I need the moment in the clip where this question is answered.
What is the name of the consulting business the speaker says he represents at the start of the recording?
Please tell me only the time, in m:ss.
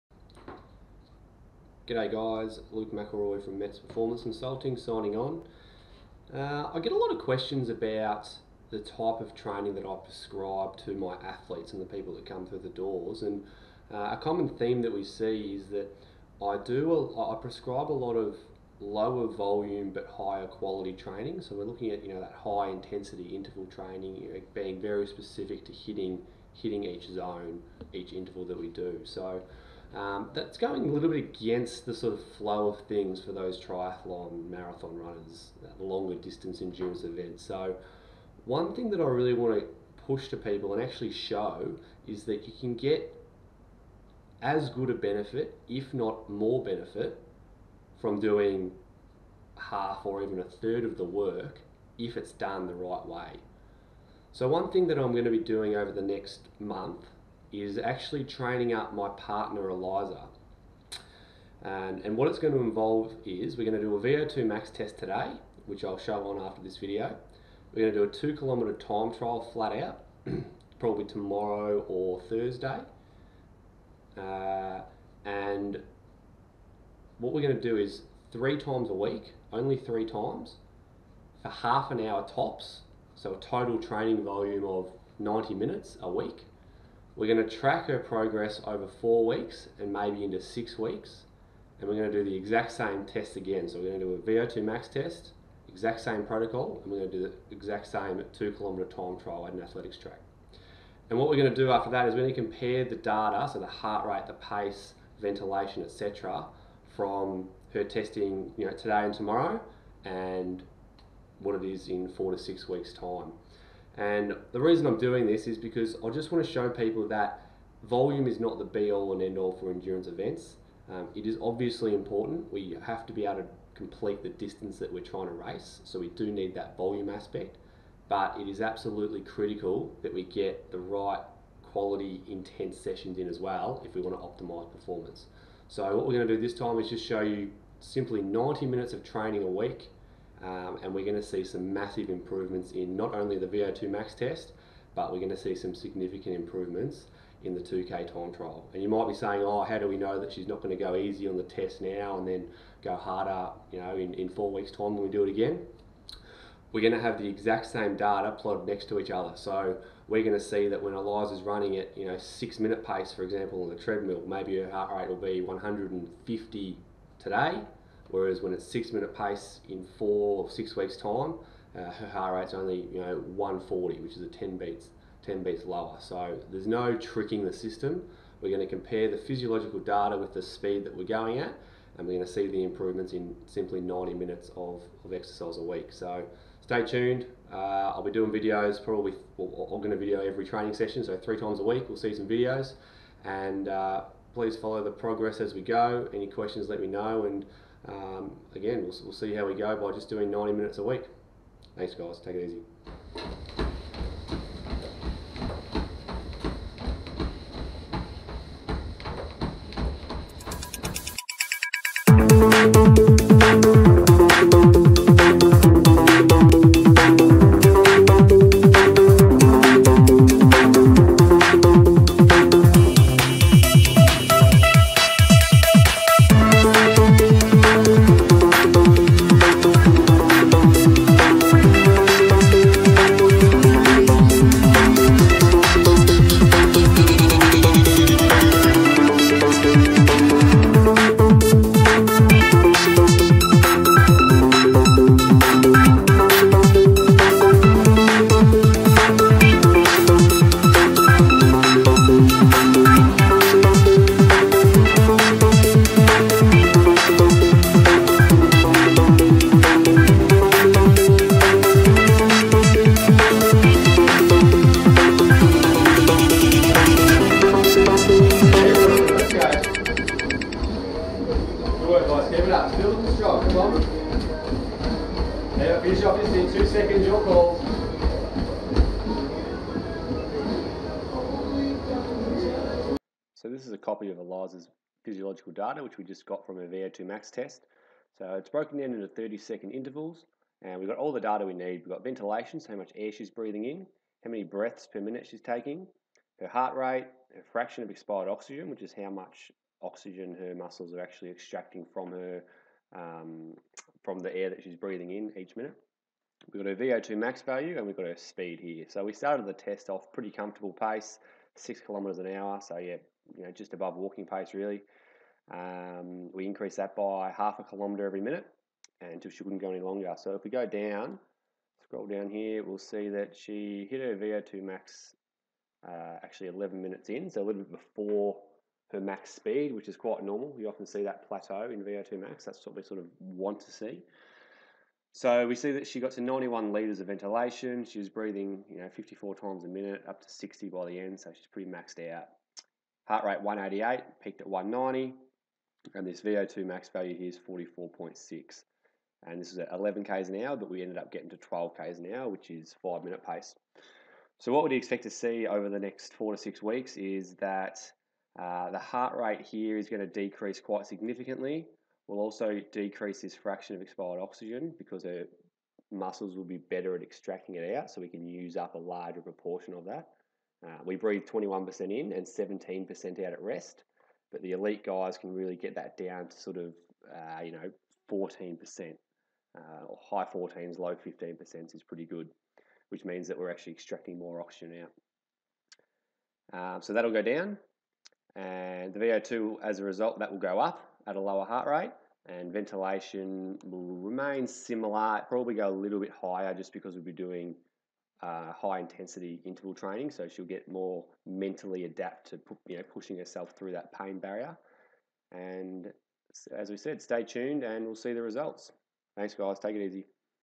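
0:03.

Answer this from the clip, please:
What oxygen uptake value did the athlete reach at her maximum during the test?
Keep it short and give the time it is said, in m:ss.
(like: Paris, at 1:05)
44.6, at 5:47.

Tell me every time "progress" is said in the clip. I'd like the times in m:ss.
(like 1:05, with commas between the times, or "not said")
1:27, 3:14.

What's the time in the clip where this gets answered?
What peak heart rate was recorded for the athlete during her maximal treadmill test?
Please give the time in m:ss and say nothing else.
5:44.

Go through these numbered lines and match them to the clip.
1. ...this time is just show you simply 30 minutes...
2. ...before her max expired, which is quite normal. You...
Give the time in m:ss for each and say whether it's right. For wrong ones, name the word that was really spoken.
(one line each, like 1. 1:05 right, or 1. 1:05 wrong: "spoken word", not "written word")
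1. 2:16 wrong: "90", not "30"
2. 5:27 wrong: "speed", not "expired".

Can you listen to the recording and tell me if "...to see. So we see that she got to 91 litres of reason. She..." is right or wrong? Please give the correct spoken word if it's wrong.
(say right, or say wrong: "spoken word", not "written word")
wrong: "ventilation", not "reason".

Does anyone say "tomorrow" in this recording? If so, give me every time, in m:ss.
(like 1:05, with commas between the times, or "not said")
1:11, 1:49.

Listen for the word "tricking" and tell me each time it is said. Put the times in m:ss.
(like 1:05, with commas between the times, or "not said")
2:56.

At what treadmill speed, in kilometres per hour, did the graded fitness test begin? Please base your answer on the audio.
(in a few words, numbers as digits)
6.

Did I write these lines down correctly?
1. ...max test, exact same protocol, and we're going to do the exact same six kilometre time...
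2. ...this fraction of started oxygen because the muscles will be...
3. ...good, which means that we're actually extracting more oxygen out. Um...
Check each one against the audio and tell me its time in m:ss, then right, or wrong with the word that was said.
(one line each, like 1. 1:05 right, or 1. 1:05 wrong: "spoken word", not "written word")
1. 1:34 wrong: "two", not "six"
2. 6:03 wrong: "expired", not "started"
3. 6:22 right.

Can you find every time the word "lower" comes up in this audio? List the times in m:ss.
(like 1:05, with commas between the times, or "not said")
0:18, 2:55, 6:31.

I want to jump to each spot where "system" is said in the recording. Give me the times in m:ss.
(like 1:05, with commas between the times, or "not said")
2:57.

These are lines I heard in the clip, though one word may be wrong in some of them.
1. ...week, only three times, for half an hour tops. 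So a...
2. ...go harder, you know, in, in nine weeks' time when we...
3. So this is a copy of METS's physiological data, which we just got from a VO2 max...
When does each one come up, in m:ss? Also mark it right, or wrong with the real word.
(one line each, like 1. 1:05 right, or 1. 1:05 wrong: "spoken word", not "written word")
1. 1:18 right
2. 2:32 wrong: "four", not "nine"
3. 4:43 wrong: "Eliza", not "METS".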